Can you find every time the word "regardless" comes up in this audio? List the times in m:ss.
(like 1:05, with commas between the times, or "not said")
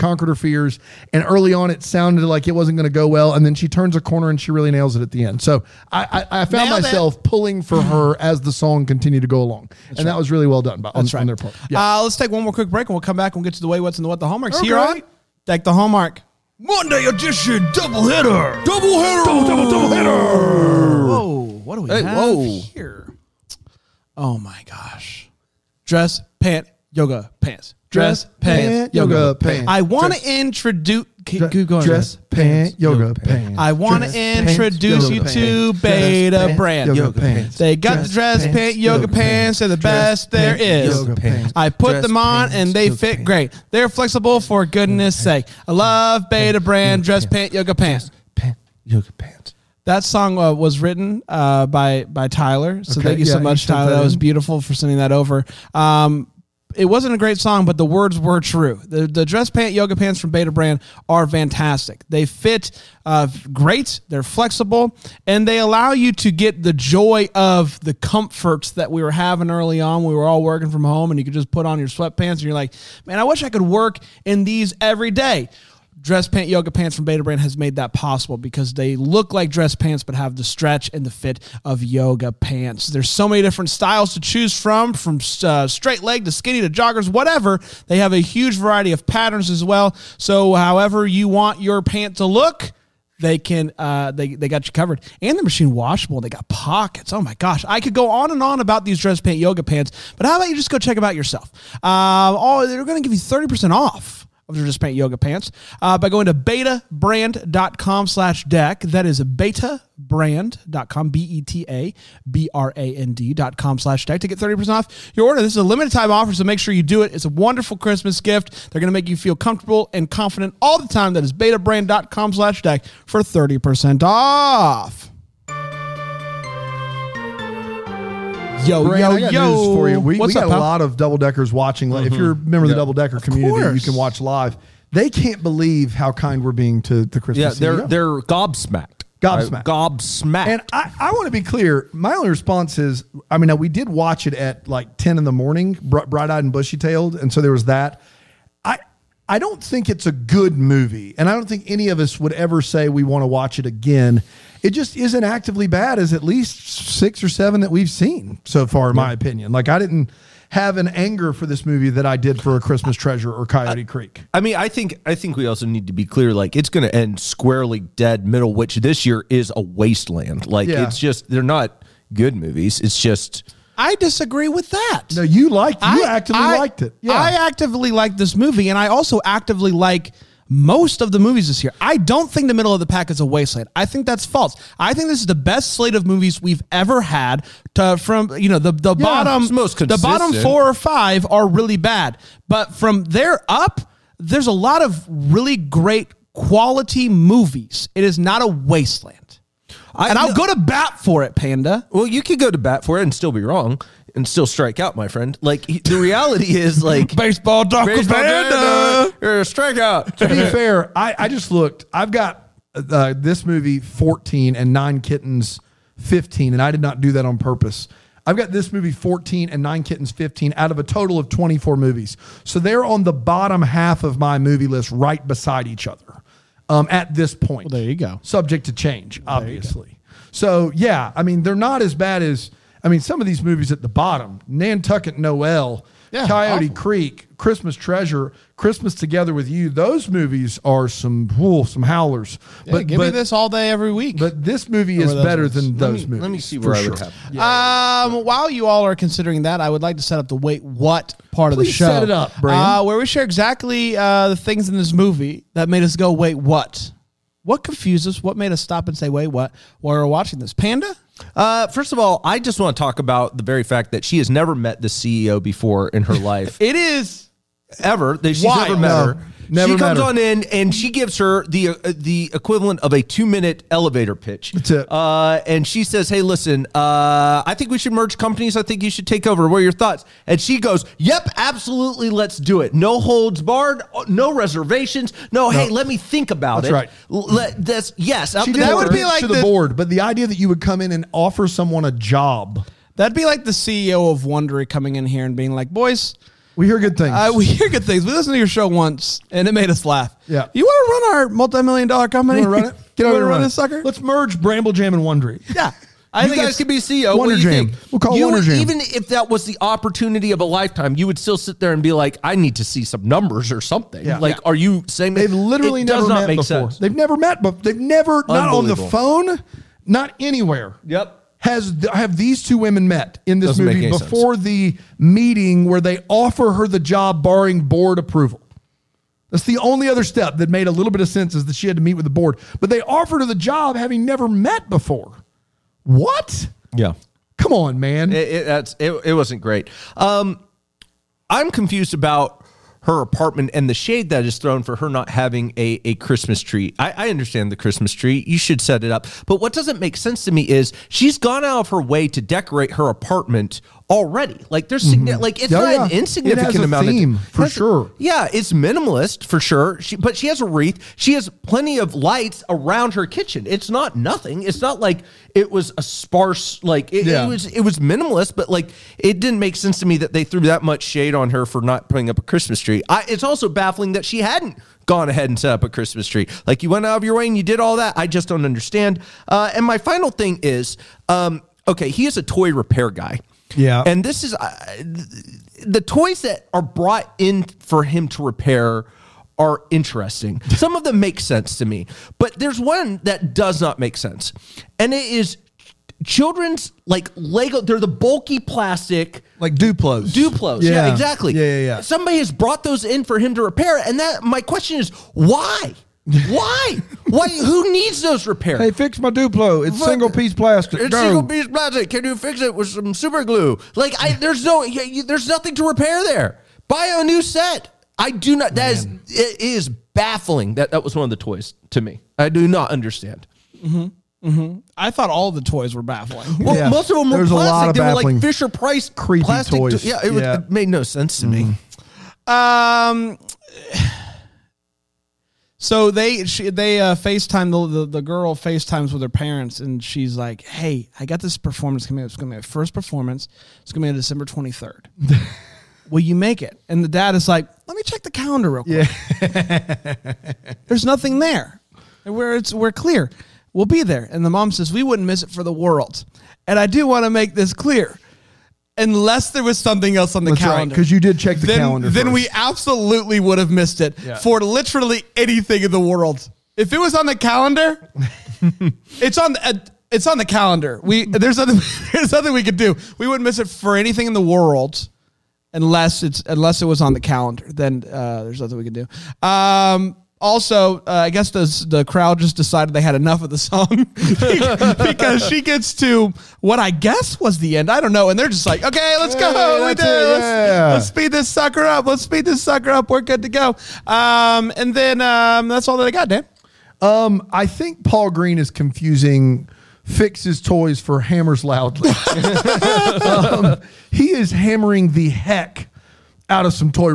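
not said.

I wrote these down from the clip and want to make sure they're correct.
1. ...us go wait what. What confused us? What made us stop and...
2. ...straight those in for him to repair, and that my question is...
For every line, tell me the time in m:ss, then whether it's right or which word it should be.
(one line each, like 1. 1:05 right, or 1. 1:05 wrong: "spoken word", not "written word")
1. 4:15 right
2. 6:42 wrong: "brought", not "straight".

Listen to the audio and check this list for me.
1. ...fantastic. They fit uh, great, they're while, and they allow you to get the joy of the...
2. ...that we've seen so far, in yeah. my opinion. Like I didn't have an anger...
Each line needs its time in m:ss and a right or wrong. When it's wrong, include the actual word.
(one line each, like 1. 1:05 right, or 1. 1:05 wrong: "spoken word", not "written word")
1. 1:01 wrong: "flexible", not "while"
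2. 2:37 right.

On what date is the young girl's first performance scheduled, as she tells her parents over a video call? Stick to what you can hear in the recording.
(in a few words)
December 23.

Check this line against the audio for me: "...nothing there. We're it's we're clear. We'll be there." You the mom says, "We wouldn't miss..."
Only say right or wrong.
wrong.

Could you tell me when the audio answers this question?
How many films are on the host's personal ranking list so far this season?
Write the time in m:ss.
3:41.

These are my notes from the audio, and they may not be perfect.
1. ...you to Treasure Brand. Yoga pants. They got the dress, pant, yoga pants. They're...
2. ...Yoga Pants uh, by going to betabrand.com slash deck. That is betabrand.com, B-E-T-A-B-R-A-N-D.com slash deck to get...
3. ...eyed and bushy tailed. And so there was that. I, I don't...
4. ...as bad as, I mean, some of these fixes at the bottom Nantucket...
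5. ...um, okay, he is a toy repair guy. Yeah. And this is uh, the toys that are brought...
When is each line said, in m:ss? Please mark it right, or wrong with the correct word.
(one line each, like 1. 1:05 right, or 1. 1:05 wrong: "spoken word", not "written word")
1. 0:35 wrong: "Beta", not "Treasure"
2. 1:44 right
3. 2:26 right
4. 3:51 wrong: "movies", not "fixes"
5. 6:21 right.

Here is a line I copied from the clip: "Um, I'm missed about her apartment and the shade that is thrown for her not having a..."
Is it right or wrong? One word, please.
wrong.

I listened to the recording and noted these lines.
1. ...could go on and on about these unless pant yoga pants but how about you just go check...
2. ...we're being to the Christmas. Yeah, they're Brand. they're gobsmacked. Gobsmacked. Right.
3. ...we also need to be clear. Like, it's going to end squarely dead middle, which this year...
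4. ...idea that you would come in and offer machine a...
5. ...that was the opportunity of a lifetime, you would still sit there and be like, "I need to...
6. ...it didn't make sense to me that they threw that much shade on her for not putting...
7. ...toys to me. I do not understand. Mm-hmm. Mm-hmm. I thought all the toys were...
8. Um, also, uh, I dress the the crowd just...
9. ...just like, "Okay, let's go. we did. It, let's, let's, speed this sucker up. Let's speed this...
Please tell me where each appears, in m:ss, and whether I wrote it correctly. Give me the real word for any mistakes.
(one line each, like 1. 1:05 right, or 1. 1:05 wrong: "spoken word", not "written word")
1. 1:37 wrong: "dress", not "unless"
2. 2:16 wrong: "CEO", not "Brand"
3. 2:45 right
4. 4:50 wrong: "someone", not "machine"
5. 5:09 right
6. 6:08 right
7. 7:01 right
8. 7:59 wrong: "guess", not "dress"
9. 8:08 right.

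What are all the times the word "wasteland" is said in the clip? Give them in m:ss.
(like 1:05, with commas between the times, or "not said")
2:49, 3:03, 3:18.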